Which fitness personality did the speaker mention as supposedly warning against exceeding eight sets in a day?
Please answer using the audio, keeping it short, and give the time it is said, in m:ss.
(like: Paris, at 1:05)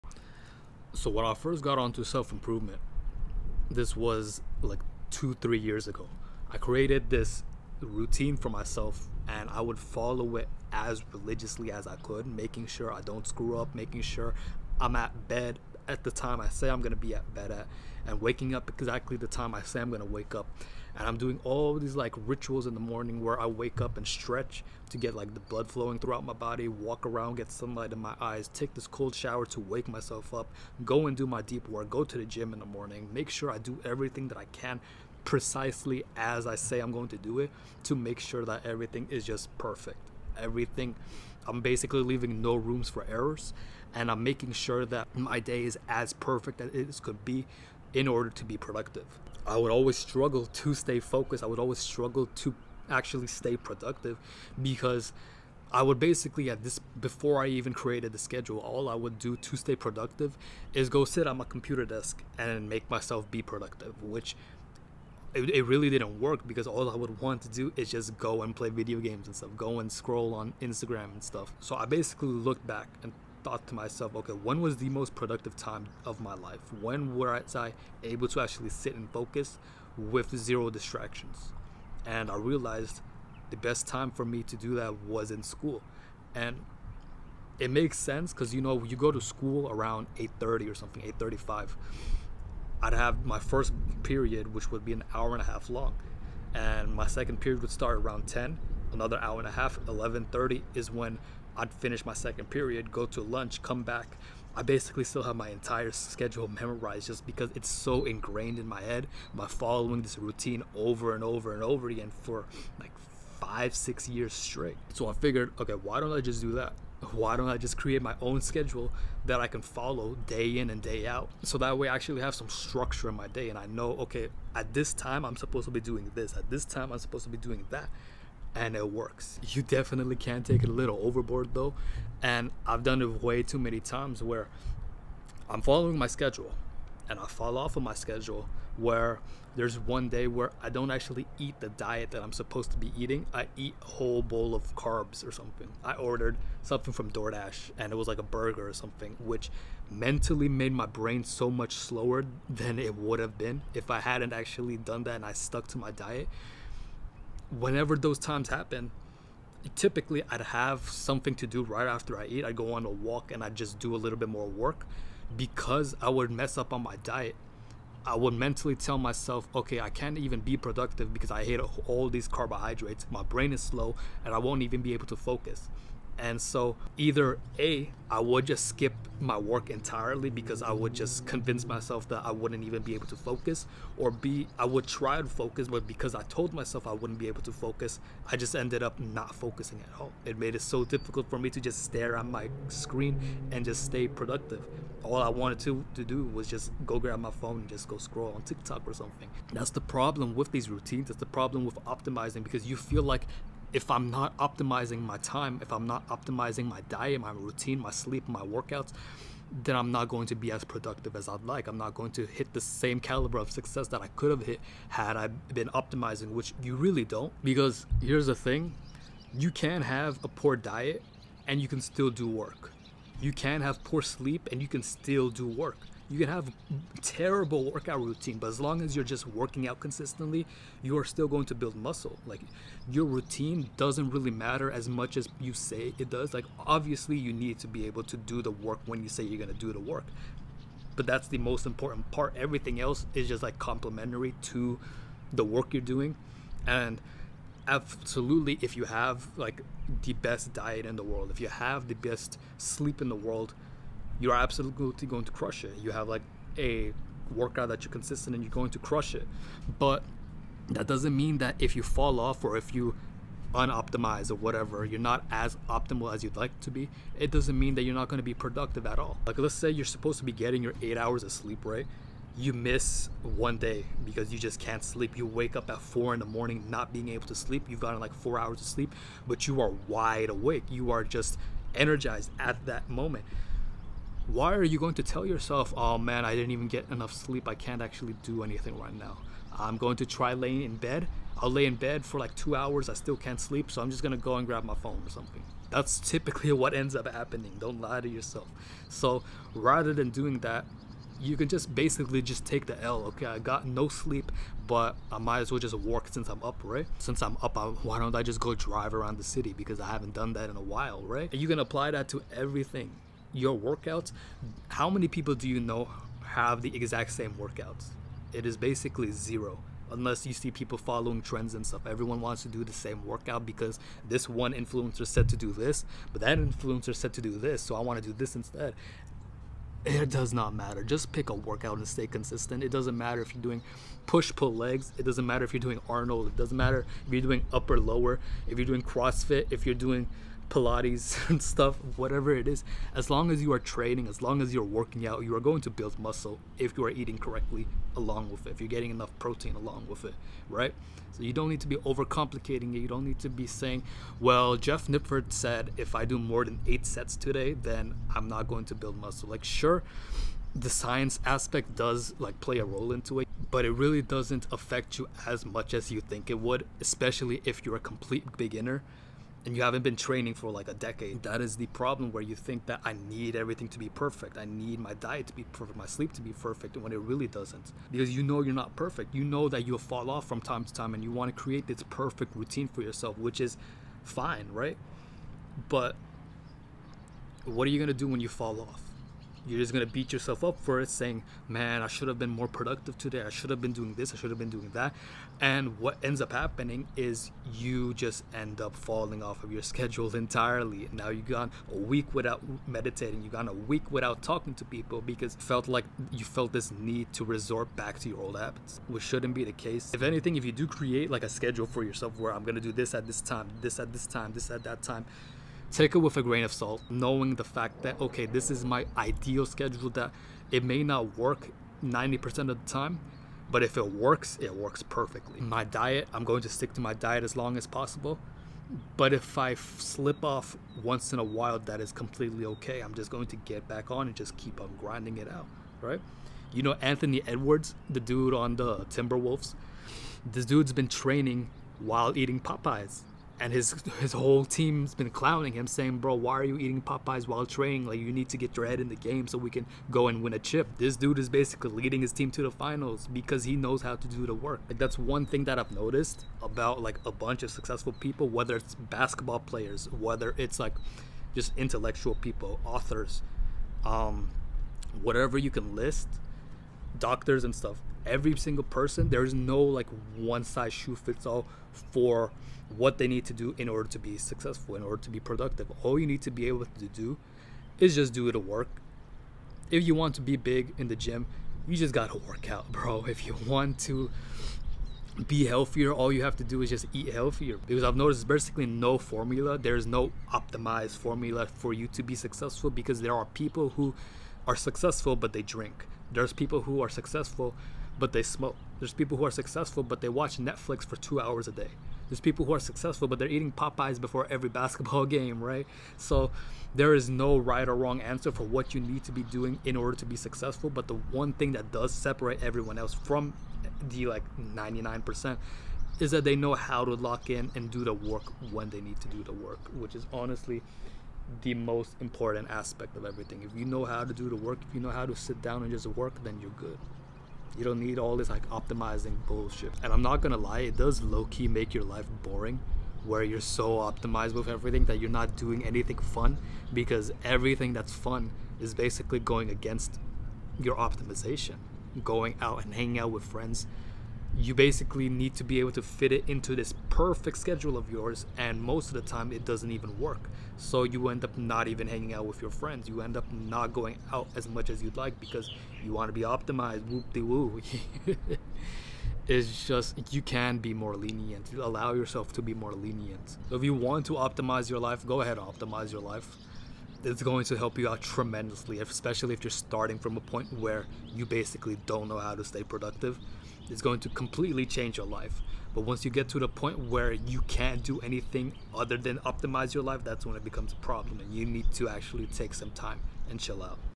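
Jeff Nippard, at 5:54.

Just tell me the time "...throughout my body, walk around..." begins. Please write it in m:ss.
0:25.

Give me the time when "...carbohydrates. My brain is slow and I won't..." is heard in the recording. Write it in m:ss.
2:52.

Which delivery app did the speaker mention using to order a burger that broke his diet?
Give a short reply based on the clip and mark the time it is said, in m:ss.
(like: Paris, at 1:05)
DoorDash, at 2:27.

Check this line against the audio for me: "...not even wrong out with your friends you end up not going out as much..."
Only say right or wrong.
wrong.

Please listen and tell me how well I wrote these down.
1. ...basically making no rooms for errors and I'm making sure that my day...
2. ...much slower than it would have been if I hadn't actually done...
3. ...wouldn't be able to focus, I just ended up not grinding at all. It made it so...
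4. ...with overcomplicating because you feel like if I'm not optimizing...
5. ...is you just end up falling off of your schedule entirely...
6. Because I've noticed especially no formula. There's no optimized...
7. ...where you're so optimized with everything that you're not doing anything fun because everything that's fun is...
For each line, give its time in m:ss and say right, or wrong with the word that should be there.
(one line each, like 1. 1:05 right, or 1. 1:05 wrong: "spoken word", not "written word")
1. 0:41 wrong: "leaving", not "making"
2. 2:31 right
3. 3:06 wrong: "focusing", not "grinding"
4. 3:21 wrong: "optimizing", not "overcomplicating"
5. 6:36 right
6. 8:07 wrong: "basically", not "especially"
7. 8:53 right.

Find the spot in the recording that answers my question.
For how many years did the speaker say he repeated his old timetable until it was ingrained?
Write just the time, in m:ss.
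1:53.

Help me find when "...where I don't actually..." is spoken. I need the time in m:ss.
2:20.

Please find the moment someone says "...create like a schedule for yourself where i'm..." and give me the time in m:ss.
6:50.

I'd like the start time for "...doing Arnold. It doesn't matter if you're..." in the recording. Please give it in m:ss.
5:35.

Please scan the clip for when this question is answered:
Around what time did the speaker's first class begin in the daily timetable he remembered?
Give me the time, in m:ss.
1:31.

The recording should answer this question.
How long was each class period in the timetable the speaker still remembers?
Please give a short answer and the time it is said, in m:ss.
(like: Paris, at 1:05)
an hour and a half, at 1:34.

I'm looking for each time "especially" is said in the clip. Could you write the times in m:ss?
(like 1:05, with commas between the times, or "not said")
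6:06, 9:28.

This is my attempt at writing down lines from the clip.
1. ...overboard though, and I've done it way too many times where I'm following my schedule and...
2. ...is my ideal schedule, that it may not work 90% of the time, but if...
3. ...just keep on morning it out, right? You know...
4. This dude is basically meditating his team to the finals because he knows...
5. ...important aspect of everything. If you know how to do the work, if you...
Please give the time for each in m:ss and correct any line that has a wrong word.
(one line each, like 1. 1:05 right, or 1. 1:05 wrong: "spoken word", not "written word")
1. 2:11 right
2. 6:58 right
3. 7:14 wrong: "grinding", not "morning"
4. 7:30 wrong: "leading", not "meditating"
5. 8:42 right.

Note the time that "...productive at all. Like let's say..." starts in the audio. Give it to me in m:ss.
4:28.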